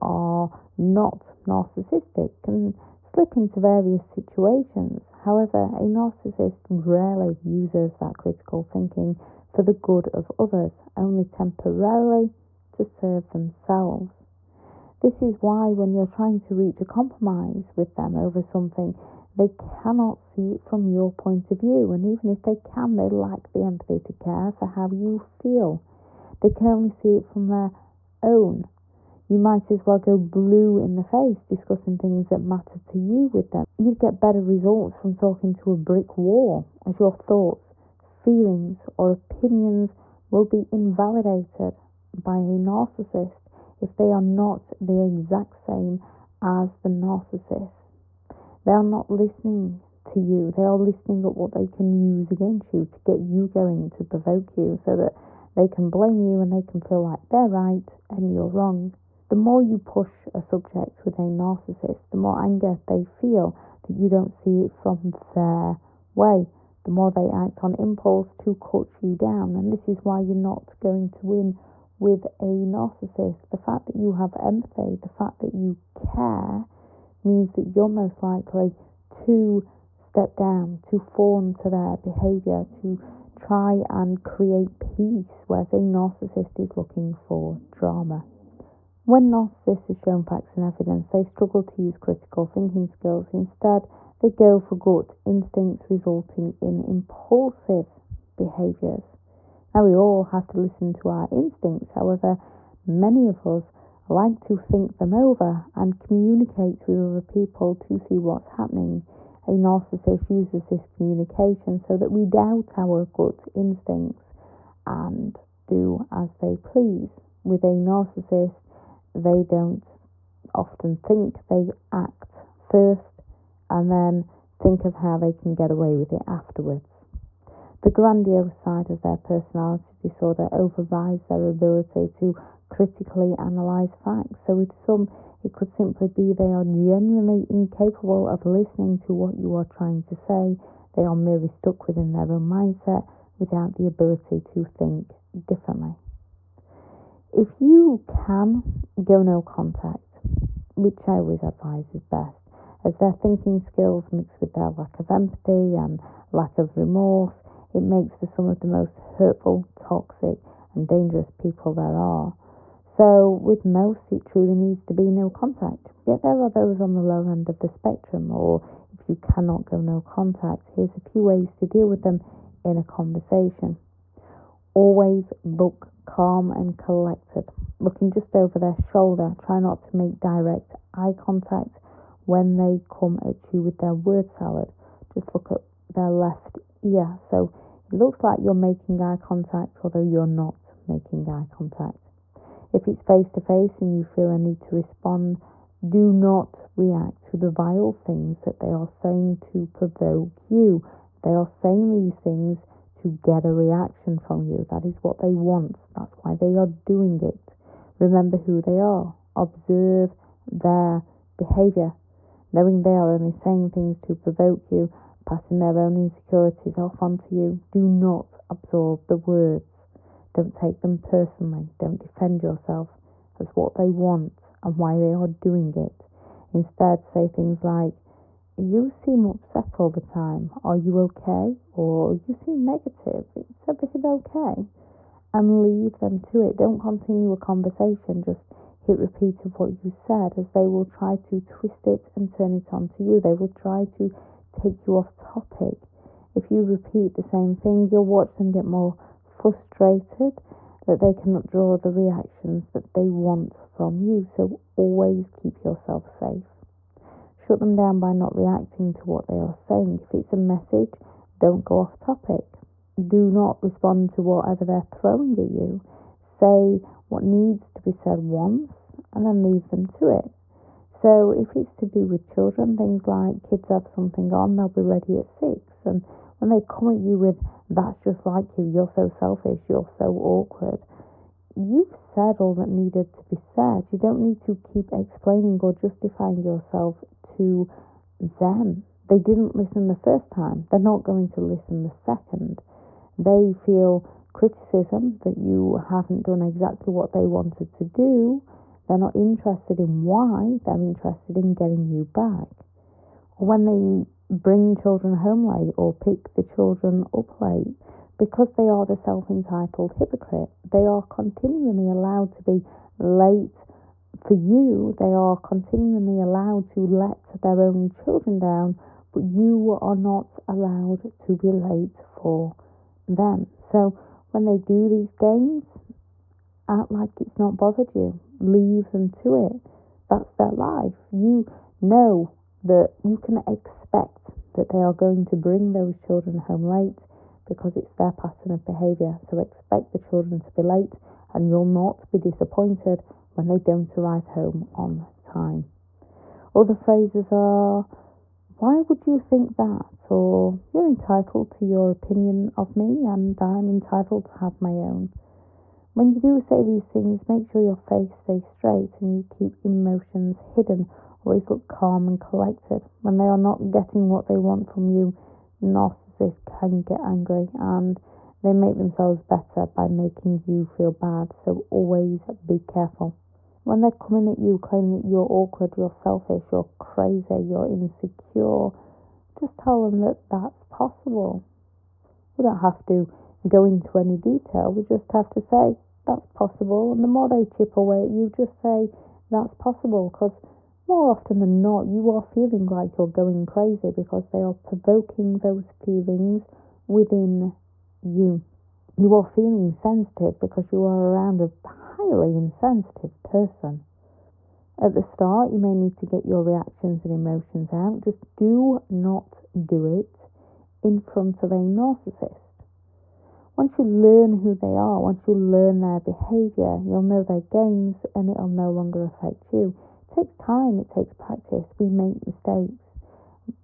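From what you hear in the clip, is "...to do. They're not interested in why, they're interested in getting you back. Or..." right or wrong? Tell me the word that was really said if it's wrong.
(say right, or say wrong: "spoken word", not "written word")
right.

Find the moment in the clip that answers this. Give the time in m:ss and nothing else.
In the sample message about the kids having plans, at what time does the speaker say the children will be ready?
4:35.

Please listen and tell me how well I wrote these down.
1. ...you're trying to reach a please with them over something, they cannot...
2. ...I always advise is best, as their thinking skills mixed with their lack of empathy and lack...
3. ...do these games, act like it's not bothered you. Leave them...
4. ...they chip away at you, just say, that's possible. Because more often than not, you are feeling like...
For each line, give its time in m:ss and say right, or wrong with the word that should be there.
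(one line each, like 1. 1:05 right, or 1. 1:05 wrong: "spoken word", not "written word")
1. 0:15 wrong: "compromise", not "please"
2. 2:31 right
3. 5:24 right
4. 6:27 right.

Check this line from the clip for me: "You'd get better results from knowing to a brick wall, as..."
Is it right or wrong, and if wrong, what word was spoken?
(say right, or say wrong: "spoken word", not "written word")
wrong: "talking", not "knowing".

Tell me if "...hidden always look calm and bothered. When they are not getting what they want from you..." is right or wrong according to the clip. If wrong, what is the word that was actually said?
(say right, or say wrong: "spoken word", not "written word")
wrong: "collected", not "bothered".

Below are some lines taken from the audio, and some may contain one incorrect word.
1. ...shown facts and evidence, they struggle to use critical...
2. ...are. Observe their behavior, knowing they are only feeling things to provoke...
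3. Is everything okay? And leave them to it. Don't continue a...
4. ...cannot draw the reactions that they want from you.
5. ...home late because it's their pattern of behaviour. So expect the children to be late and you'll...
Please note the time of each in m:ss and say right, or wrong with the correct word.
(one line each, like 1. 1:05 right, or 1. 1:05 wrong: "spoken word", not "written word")
1. 1:29 right
2. 3:28 wrong: "saying", not "feeling"
3. 3:53 right
4. 4:11 right
5. 5:36 right.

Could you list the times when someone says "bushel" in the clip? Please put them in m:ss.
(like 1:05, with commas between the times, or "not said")
not said.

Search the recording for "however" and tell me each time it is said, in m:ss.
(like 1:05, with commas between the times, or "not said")
0:05, 1:41.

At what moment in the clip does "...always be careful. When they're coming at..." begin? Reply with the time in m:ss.
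6:11.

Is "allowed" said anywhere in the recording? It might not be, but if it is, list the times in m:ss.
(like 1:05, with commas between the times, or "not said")
5:11, 5:16, 5:20.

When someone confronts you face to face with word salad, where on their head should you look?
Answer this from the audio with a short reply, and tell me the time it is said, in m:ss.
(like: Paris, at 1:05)
left ear, at 3:06.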